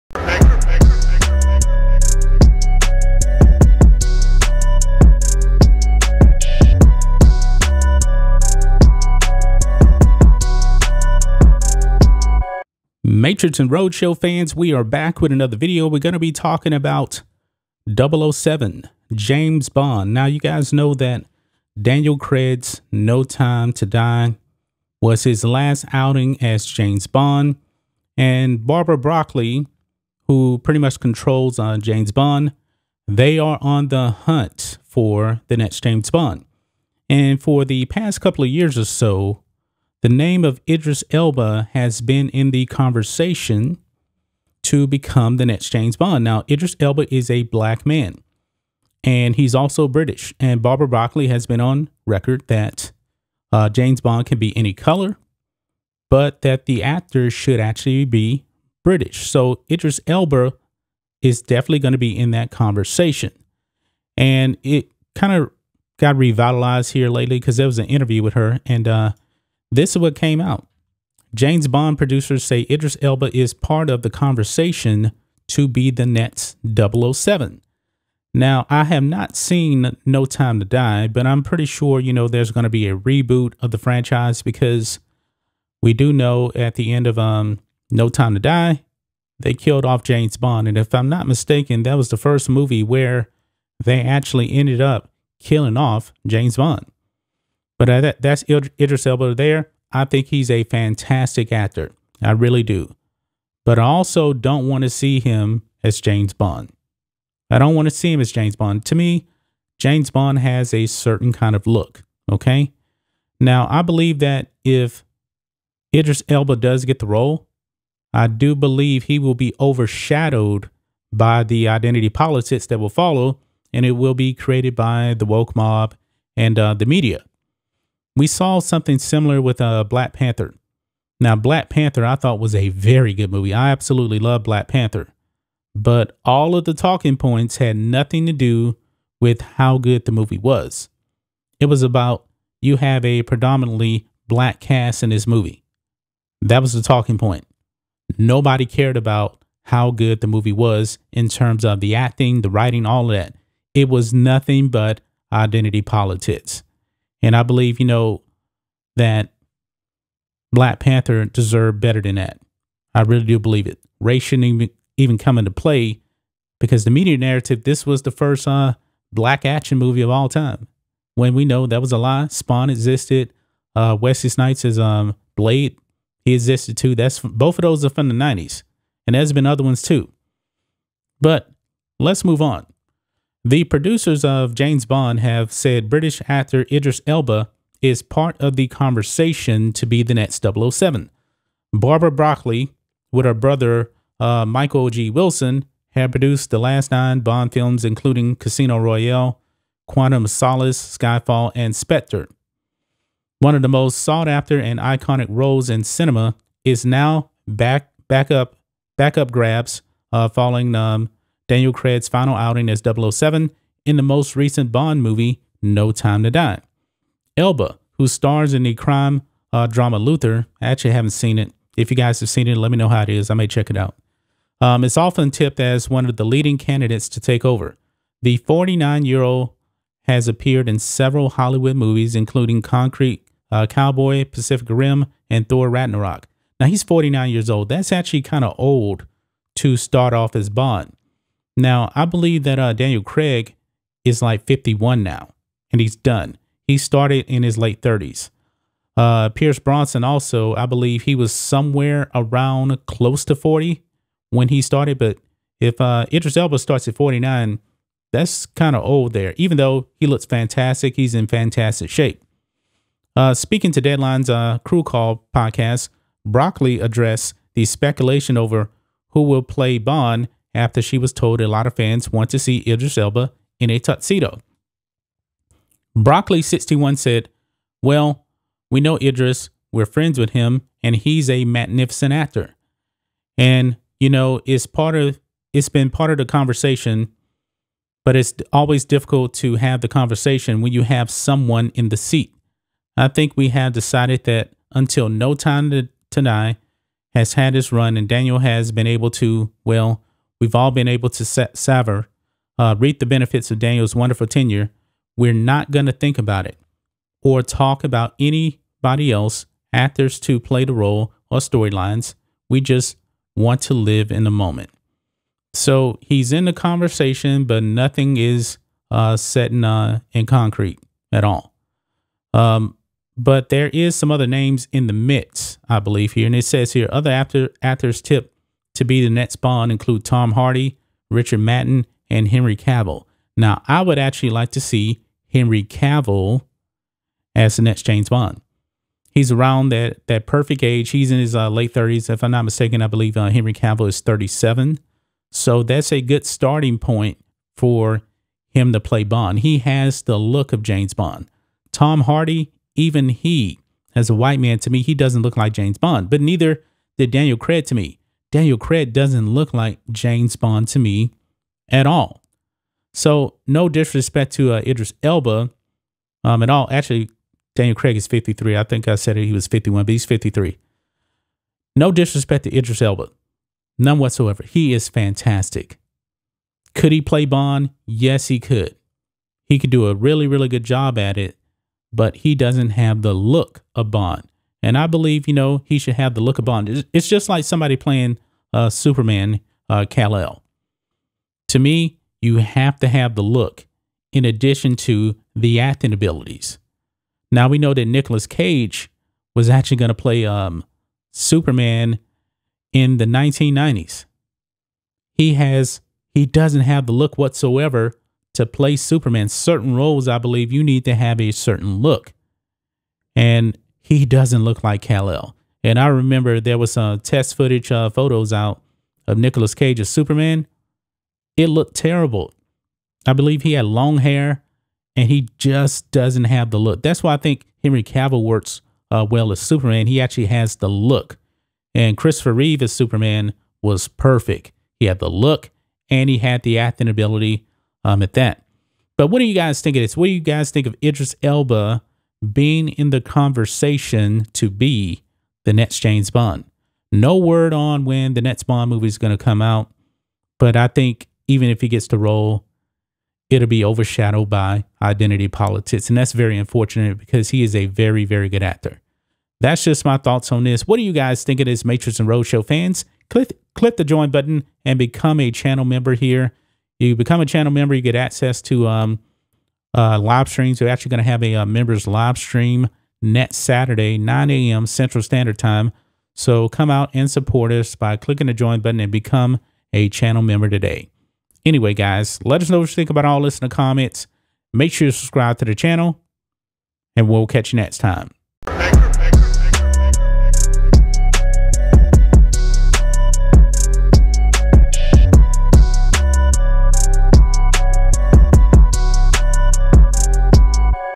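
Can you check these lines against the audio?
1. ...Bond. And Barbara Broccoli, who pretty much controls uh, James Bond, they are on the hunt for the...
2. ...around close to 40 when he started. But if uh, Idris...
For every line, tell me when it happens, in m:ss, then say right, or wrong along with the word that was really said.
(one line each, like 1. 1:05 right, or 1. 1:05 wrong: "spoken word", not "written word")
1. 0:27 right
2. 4:12 right.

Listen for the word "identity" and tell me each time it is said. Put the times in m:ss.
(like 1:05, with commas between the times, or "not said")
2:01, 2:35, 7:34.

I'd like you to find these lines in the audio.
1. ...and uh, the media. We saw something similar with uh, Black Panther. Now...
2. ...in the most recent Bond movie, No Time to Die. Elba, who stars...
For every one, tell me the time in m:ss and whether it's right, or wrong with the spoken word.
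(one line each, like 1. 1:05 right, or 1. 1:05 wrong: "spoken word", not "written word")
1. 2:06 right
2. 3:33 right.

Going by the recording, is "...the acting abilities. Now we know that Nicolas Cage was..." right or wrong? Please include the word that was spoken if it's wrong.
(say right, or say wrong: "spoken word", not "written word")
right.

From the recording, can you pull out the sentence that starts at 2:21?
It was about you have a predominantly black cast in this movie.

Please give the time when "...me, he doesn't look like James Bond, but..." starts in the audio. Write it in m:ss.
5:54.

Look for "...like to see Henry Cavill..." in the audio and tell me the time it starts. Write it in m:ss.
5:34.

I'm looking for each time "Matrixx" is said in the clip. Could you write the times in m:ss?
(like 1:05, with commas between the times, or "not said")
0:13, 7:41.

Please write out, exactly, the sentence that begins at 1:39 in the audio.
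I think he's a fantastic actor.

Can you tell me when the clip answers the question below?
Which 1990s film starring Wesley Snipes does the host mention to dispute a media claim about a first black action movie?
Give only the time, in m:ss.
2:55.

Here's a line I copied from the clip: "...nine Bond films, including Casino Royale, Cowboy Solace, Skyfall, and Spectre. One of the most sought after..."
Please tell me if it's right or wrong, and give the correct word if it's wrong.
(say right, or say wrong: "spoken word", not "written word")
wrong: "Quantum", not "Cowboy".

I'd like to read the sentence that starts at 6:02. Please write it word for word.
So no disrespect to uh, Idris Elba um, at all.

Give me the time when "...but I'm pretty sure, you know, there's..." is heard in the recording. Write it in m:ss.
1:21.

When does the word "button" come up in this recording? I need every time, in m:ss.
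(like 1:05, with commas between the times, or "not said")
7:44, 7:58.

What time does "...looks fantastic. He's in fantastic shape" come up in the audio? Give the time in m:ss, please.
4:20.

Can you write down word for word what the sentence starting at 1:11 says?
James Bond producers say Idris Elba is part of the conversation to be the next 007.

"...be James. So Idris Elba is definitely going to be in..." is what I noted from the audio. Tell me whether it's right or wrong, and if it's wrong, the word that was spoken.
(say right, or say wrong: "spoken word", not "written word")
wrong: "British", not "James".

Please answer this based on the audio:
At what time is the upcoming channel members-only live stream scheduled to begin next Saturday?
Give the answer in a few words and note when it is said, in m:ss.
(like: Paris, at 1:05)
9 a.m. Central, at 7:53.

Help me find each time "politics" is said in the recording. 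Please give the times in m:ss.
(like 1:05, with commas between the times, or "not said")
2:02, 2:35, 7:35.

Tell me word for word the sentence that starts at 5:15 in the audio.
So he's in the conversation, but nothing is uh, set in, uh, in concrete at all.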